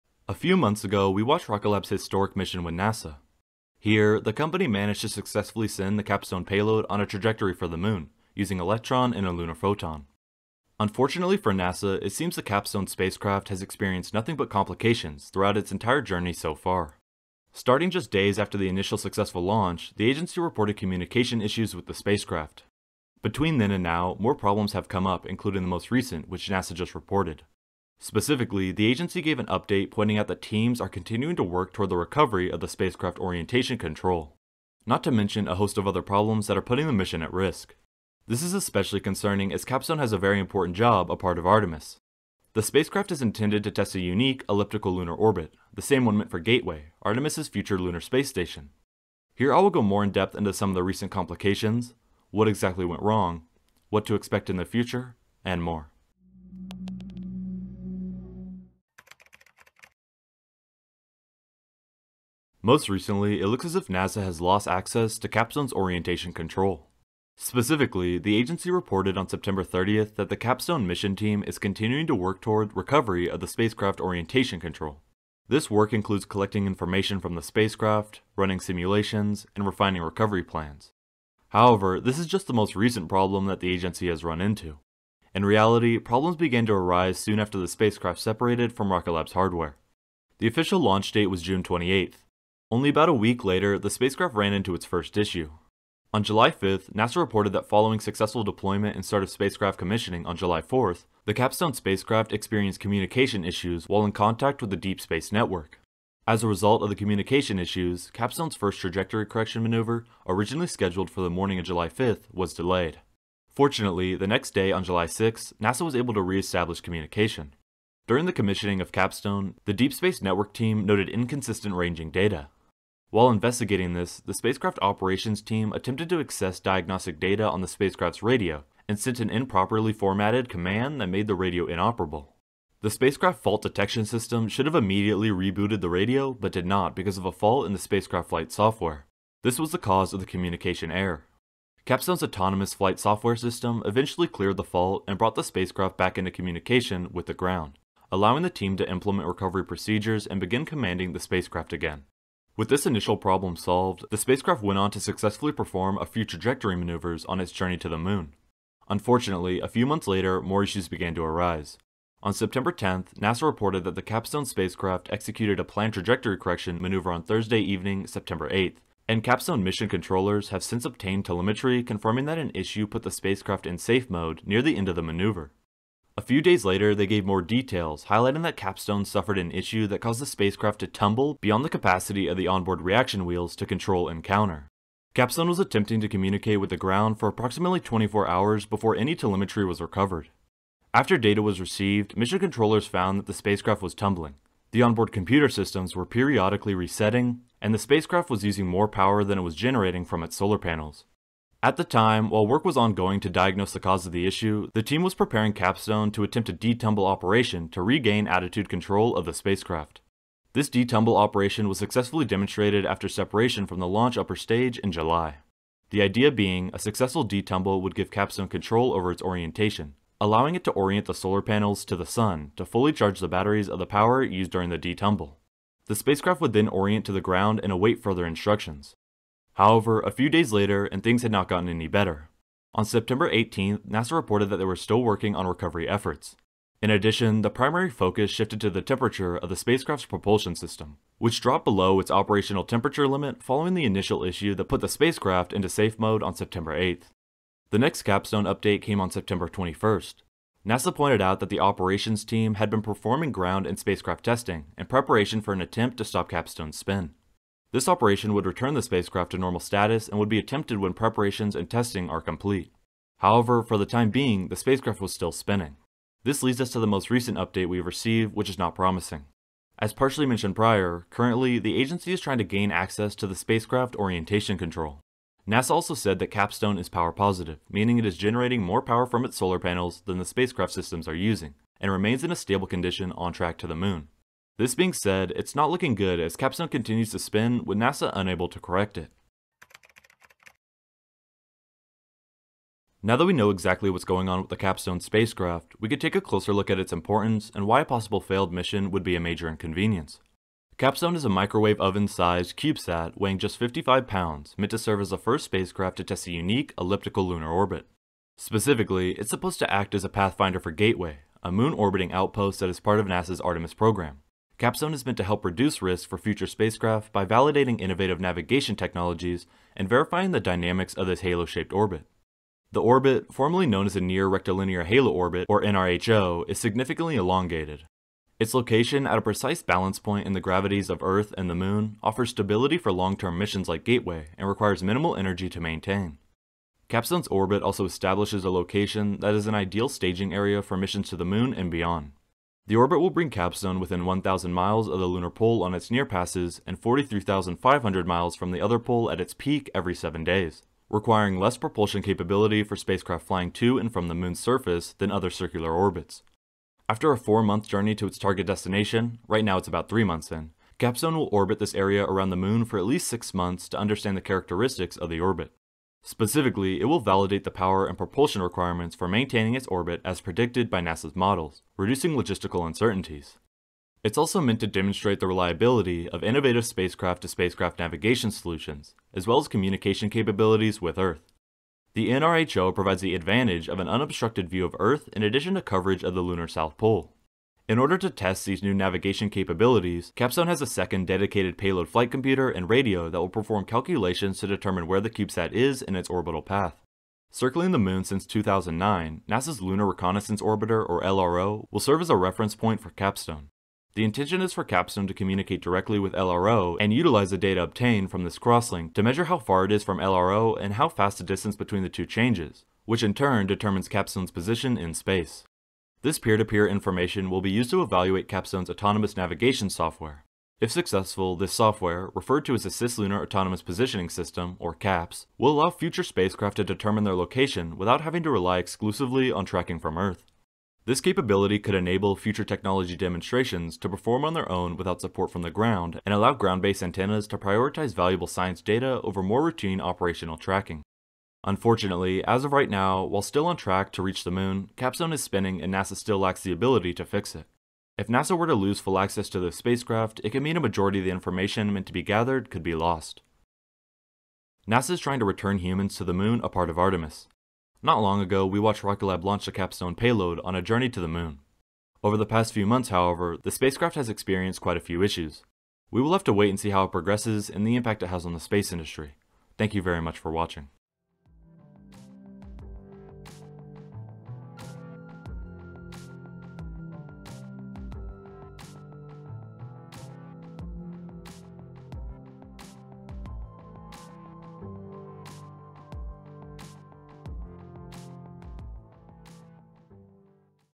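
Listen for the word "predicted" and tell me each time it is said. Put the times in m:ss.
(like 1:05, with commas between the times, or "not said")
6:10.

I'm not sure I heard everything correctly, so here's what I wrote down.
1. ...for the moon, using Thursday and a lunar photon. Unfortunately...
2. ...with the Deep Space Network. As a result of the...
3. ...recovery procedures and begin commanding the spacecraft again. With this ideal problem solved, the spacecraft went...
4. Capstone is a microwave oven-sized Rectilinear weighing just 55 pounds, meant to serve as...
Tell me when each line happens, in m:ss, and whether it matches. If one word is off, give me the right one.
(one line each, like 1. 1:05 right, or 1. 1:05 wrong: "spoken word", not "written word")
1. 0:07 wrong: "Electron", not "Thursday"
2. 1:44 right
3. 2:29 wrong: "initial", not "ideal"
4. 5:00 wrong: "CubeSat", not "Rectilinear".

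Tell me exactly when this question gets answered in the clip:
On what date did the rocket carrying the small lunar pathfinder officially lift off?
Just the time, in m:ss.
1:31.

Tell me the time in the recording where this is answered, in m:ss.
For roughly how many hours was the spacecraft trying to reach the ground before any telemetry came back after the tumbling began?
3:07.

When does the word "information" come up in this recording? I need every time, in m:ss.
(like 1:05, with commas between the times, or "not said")
1:16, 6:56, 7:31.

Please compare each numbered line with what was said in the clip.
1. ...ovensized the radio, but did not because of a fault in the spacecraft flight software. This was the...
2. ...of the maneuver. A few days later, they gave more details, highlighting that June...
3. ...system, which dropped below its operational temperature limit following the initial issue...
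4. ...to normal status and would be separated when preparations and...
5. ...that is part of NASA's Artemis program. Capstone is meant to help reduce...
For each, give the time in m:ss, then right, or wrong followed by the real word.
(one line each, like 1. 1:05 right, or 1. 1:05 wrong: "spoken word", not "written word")
1. 2:15 wrong: "rebooted", not "ovensized"
2. 2:54 wrong: "Capstone", not "June"
3. 4:00 right
4. 4:19 wrong: "attempted", not "separated"
5. 5:12 right.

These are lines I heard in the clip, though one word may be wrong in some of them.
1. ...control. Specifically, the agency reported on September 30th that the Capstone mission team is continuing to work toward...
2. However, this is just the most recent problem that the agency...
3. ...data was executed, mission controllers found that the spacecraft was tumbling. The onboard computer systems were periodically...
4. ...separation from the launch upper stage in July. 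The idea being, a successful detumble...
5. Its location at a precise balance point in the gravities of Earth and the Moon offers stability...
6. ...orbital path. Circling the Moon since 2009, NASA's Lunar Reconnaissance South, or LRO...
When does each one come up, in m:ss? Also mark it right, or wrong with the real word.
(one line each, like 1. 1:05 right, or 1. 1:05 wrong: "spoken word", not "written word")
1. 1:06 right
2. 1:21 right
3. 3:11 wrong: "received", not "executed"
4. 3:33 right
5. 5:28 right
6. 6:36 wrong: "Orbiter", not "South".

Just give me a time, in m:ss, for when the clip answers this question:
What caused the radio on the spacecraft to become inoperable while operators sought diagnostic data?
2:09.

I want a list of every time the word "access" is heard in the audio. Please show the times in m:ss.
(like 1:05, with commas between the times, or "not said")
1:04, 2:06, 4:32, 7:28.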